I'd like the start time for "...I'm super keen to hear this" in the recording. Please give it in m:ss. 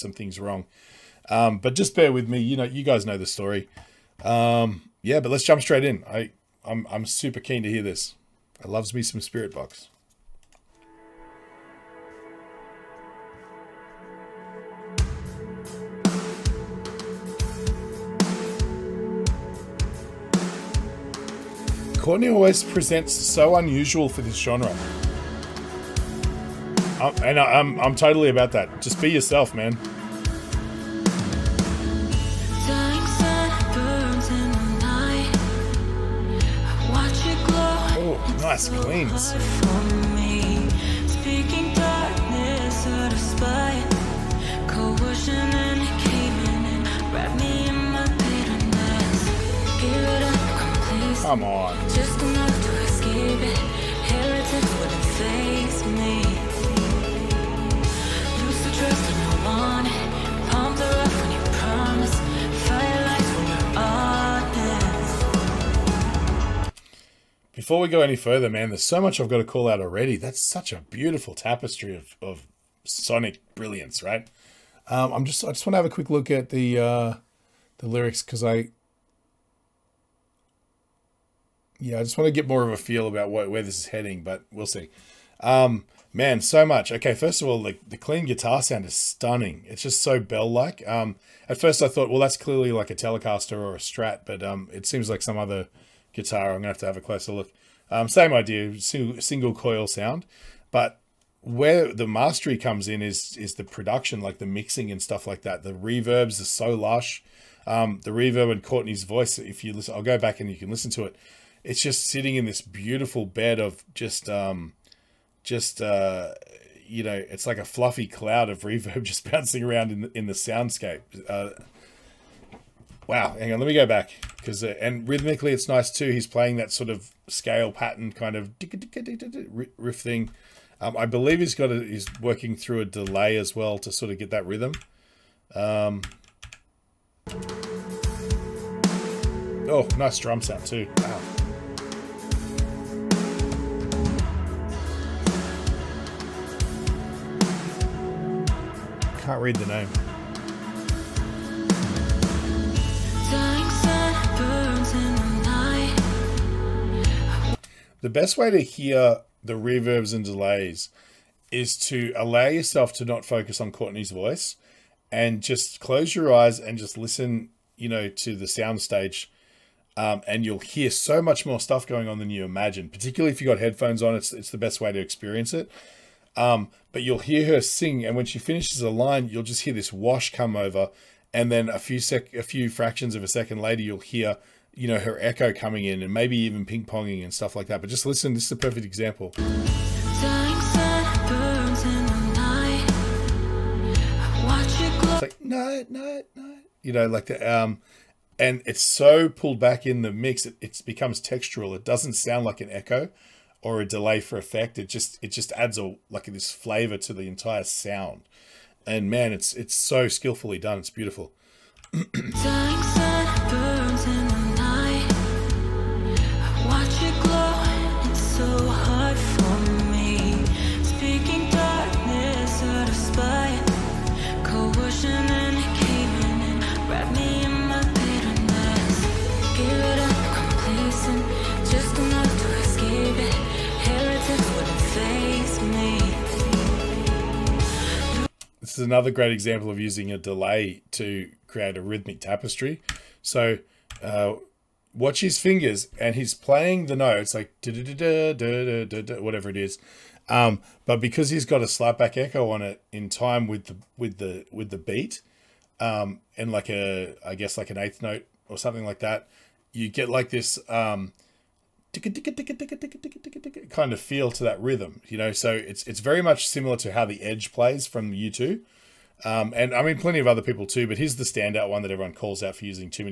0:06.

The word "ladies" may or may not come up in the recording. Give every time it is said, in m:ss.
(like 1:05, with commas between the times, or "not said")
not said.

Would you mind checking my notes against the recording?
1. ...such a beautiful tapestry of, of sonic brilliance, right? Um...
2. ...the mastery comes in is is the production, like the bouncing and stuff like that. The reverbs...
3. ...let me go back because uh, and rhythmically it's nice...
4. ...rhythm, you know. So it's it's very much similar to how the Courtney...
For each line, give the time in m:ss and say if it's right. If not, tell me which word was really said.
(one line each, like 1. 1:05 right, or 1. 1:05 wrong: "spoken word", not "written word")
1. 1:10 right
2. 1:41 wrong: "mixing", not "bouncing"
3. 2:03 right
4. 4:24 wrong: "Edge", not "Courtney".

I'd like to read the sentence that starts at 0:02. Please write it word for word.
You know, you guys know the story.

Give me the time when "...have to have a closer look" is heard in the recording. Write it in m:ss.
1:36.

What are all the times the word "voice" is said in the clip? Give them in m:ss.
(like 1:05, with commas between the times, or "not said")
1:49, 2:44.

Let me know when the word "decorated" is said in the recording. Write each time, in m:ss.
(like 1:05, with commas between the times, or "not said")
not said.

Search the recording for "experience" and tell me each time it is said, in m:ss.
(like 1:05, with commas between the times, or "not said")
2:54.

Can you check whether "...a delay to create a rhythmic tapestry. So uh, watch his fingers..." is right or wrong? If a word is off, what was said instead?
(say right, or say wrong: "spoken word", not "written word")
right.